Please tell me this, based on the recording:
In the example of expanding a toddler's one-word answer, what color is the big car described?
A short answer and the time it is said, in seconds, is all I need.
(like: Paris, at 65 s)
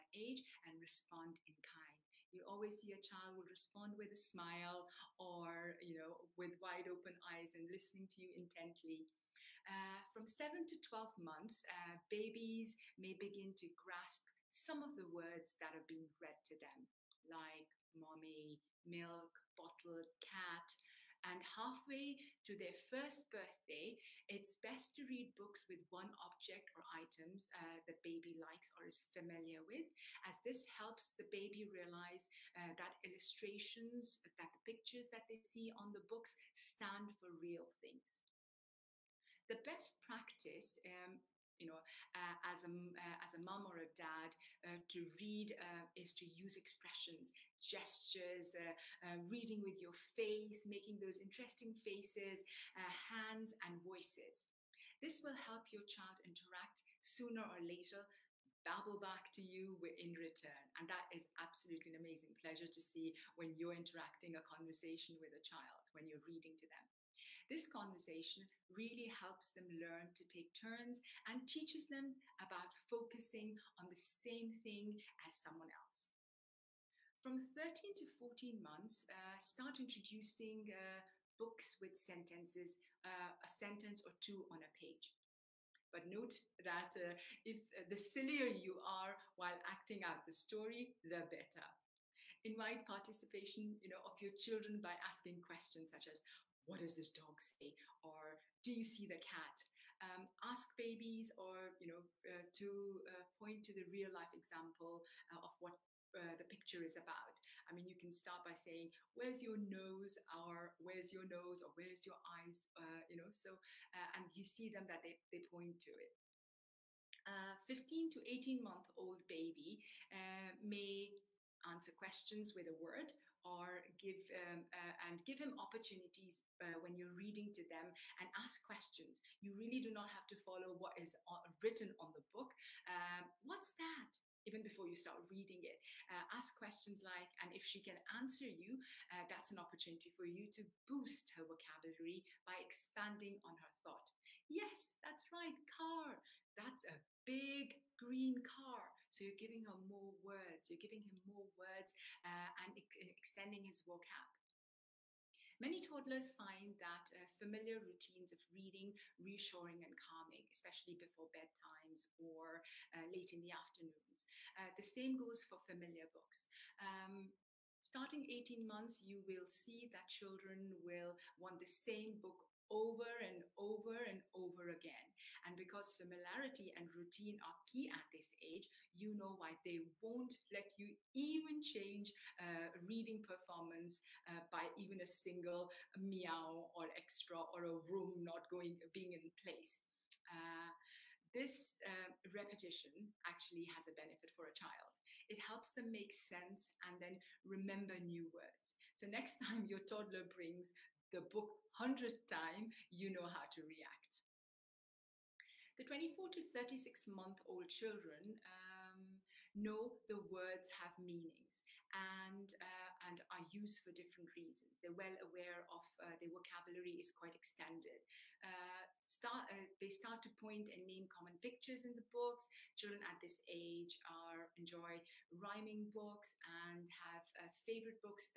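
green, at 147 s.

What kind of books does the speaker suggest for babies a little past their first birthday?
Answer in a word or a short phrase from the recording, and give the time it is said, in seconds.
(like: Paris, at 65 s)
books with sentences, at 81 s.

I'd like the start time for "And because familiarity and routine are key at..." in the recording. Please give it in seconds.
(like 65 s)
175 s.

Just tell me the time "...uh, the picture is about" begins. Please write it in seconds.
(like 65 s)
106 s.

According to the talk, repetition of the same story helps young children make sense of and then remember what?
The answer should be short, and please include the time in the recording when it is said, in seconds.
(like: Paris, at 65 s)
new words, at 197 s.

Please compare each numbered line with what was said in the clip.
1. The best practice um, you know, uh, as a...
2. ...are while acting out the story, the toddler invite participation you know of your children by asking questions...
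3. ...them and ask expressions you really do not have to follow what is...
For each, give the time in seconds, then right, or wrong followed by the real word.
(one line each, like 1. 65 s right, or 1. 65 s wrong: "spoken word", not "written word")
1. 39 s right
2. 88 s wrong: "better", not "toddler"
3. 127 s wrong: "questions", not "expressions".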